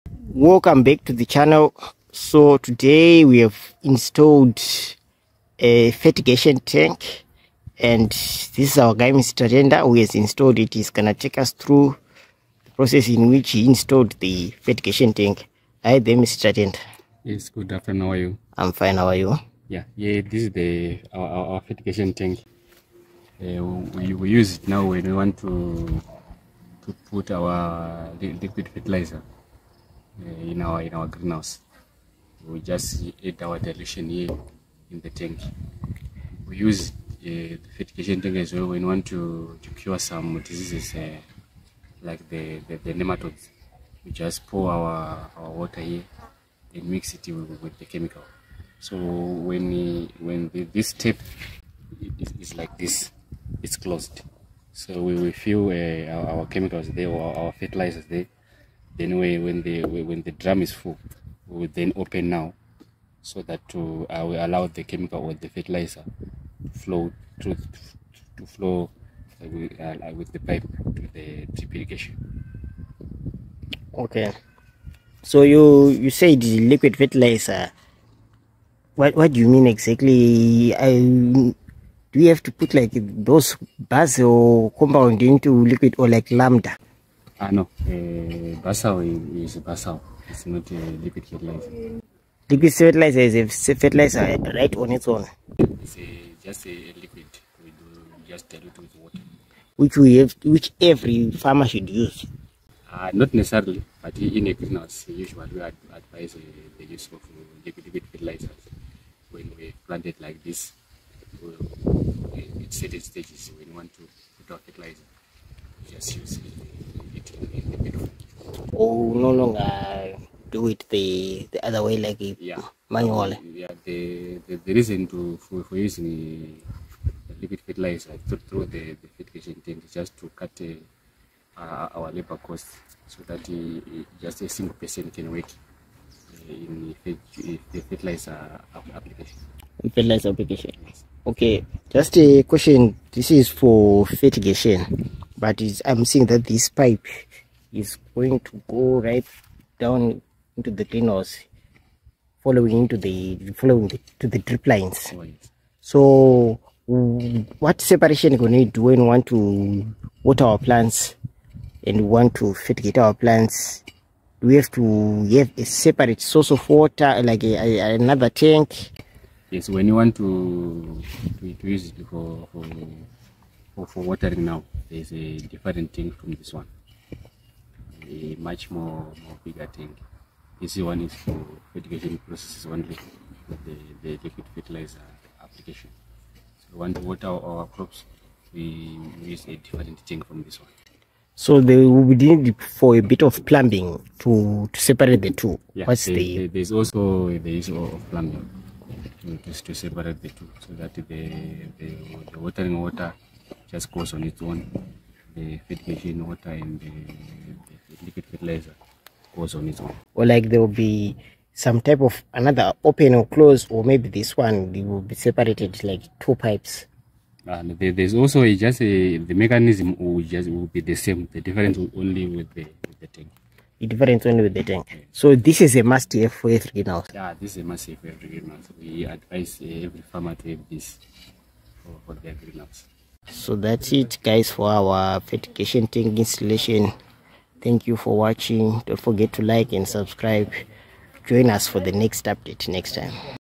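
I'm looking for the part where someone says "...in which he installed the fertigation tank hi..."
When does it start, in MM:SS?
00:13.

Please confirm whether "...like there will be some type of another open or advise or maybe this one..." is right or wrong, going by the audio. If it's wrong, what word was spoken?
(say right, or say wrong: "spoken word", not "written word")
wrong: "close", not "advise".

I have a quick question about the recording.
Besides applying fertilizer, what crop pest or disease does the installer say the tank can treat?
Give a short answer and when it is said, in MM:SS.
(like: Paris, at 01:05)
nematodes, at 00:42.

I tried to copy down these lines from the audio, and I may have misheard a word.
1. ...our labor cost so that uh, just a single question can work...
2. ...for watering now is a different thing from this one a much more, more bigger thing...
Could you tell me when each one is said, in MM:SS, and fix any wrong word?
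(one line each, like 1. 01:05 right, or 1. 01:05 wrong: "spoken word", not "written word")
1. 02:11 wrong: "person", not "question"
2. 02:53 right.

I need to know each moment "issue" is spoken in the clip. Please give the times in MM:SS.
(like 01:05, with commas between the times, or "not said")
03:17.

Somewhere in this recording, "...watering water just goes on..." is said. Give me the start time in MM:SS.
03:22.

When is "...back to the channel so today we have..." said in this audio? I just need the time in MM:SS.
00:00.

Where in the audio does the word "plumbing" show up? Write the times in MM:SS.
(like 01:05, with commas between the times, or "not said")
03:13, 03:18.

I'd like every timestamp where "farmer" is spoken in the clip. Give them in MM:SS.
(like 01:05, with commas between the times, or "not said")
01:41, 03:50.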